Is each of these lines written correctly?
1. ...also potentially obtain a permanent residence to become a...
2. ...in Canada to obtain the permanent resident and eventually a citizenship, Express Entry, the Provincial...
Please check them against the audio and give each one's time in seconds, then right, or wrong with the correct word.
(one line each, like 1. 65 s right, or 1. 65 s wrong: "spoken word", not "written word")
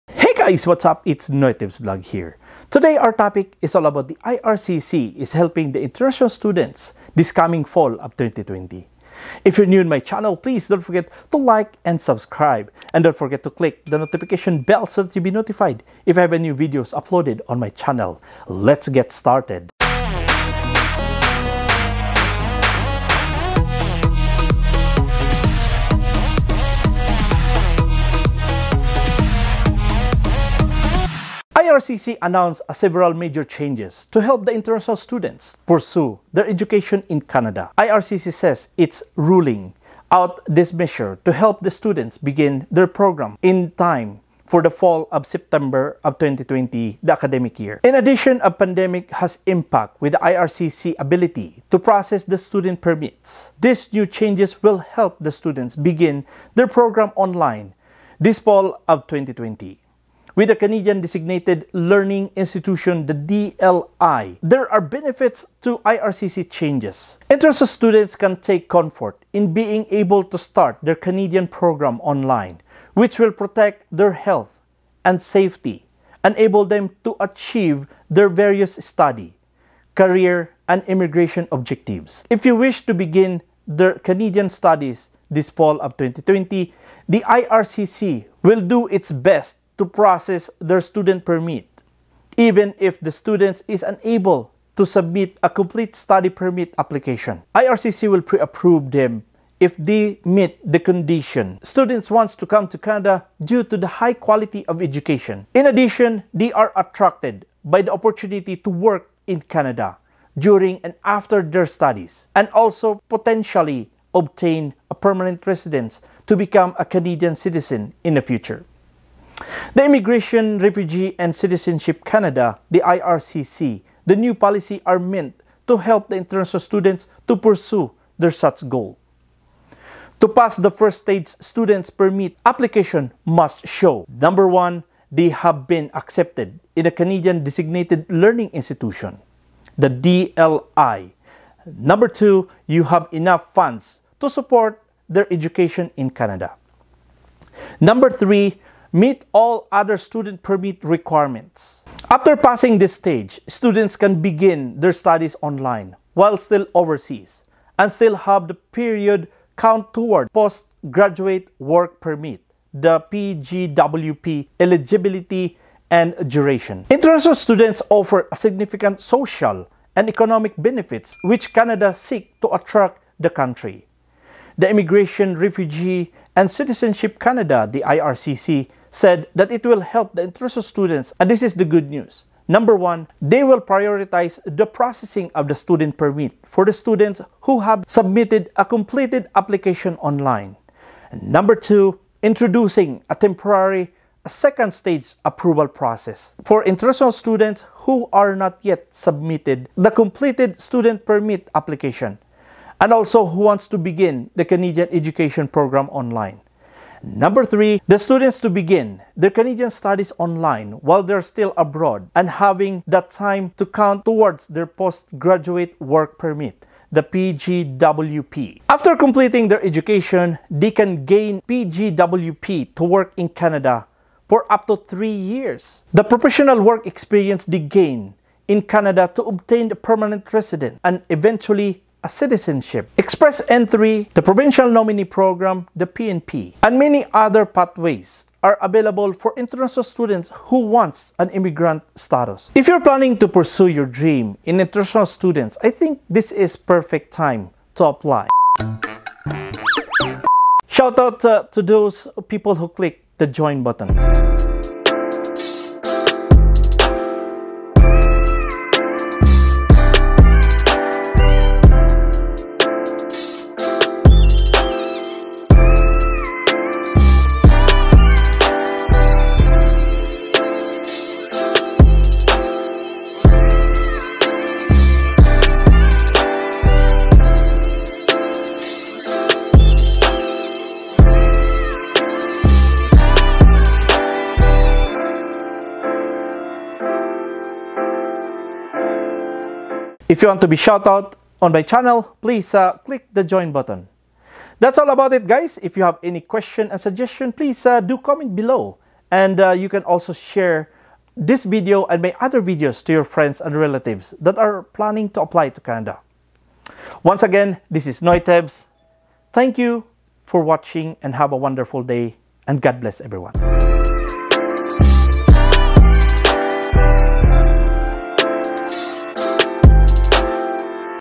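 1. 112 s right
2. 228 s right.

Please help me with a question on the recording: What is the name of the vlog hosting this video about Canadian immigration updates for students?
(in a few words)
NoyTebs Vlog.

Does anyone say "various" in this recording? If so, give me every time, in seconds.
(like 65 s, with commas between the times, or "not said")
78 s.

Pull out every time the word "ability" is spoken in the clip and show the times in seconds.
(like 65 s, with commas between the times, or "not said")
50 s.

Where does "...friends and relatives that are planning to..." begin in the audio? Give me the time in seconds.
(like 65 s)
303 s.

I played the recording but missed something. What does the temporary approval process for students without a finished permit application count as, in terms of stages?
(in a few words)
second stage.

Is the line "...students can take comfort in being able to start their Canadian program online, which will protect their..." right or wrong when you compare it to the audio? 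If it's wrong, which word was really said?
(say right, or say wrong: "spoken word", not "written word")
right.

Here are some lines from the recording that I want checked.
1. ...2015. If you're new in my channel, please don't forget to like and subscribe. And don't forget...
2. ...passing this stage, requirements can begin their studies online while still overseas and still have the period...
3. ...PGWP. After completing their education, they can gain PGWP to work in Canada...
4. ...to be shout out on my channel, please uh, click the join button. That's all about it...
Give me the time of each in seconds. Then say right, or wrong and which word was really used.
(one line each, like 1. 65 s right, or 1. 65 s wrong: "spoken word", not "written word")
1. 8 s wrong: "2020", not "2015"
2. 152 s wrong: "students", not "requirements"
3. 217 s right
4. 290 s right.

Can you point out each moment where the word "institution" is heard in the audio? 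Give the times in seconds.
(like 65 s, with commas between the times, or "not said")
62 s, 138 s.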